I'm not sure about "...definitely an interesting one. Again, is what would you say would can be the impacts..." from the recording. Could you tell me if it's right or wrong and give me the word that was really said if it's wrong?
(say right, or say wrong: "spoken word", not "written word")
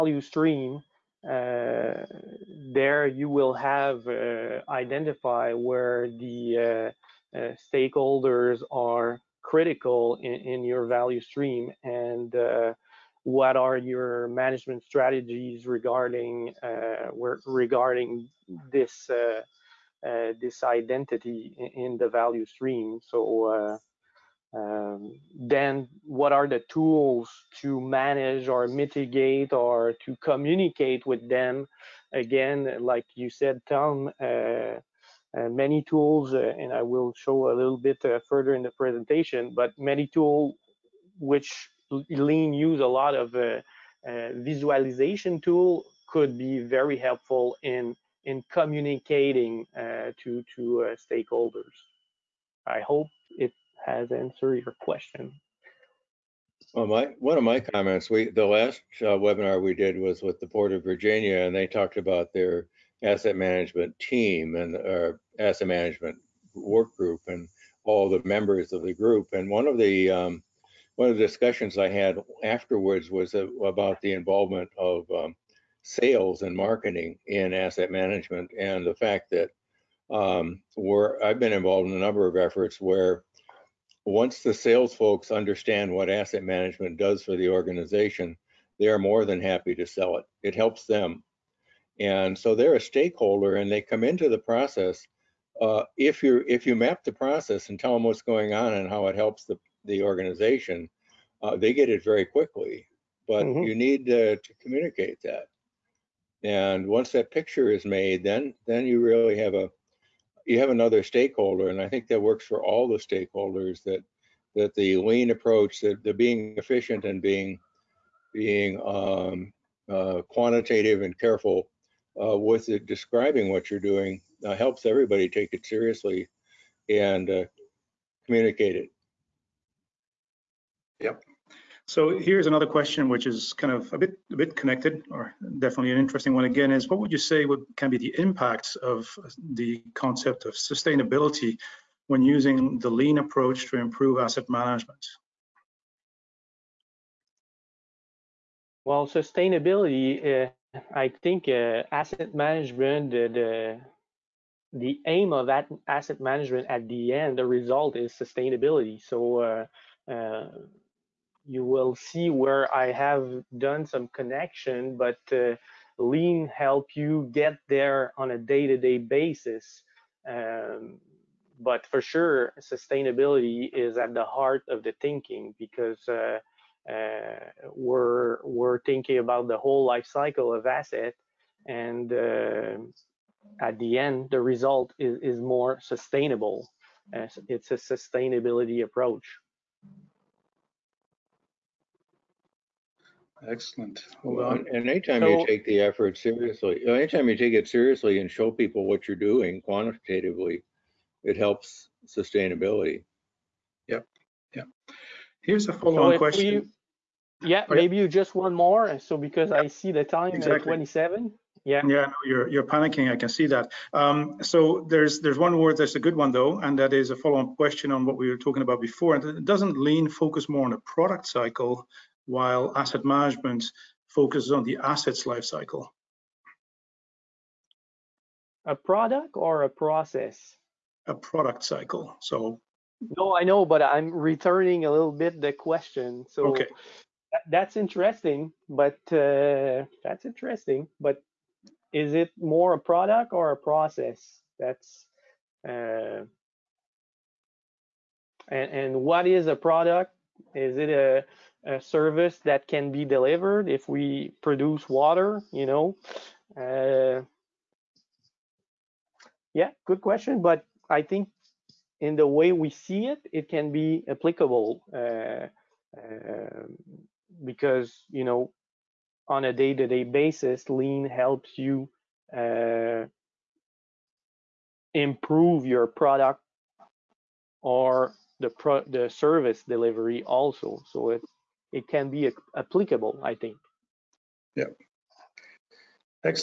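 right.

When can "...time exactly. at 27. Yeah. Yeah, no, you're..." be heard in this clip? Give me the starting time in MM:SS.
03:30.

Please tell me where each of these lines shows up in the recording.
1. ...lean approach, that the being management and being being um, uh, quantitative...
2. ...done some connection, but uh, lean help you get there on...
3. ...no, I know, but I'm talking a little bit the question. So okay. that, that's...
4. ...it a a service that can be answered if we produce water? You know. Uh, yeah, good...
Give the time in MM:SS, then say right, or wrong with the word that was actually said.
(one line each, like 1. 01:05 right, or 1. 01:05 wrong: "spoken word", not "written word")
1. 01:55 wrong: "efficient", not "management"
2. 02:43 right
3. 03:53 wrong: "returning", not "talking"
4. 04:10 wrong: "delivered", not "answered".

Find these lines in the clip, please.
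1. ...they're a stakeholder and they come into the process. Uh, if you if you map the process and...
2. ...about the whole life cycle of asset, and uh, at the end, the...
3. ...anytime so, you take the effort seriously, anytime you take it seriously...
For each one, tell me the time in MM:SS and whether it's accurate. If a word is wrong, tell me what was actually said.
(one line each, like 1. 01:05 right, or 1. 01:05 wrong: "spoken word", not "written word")
1. 01:32 right
2. 02:59 right
3. 03:14 right.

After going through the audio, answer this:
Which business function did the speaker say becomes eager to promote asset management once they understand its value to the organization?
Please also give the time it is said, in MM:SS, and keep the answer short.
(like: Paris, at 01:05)
Sales and marketing, at 01:15.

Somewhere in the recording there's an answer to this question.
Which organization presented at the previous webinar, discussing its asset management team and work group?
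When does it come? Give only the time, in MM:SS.
01:00.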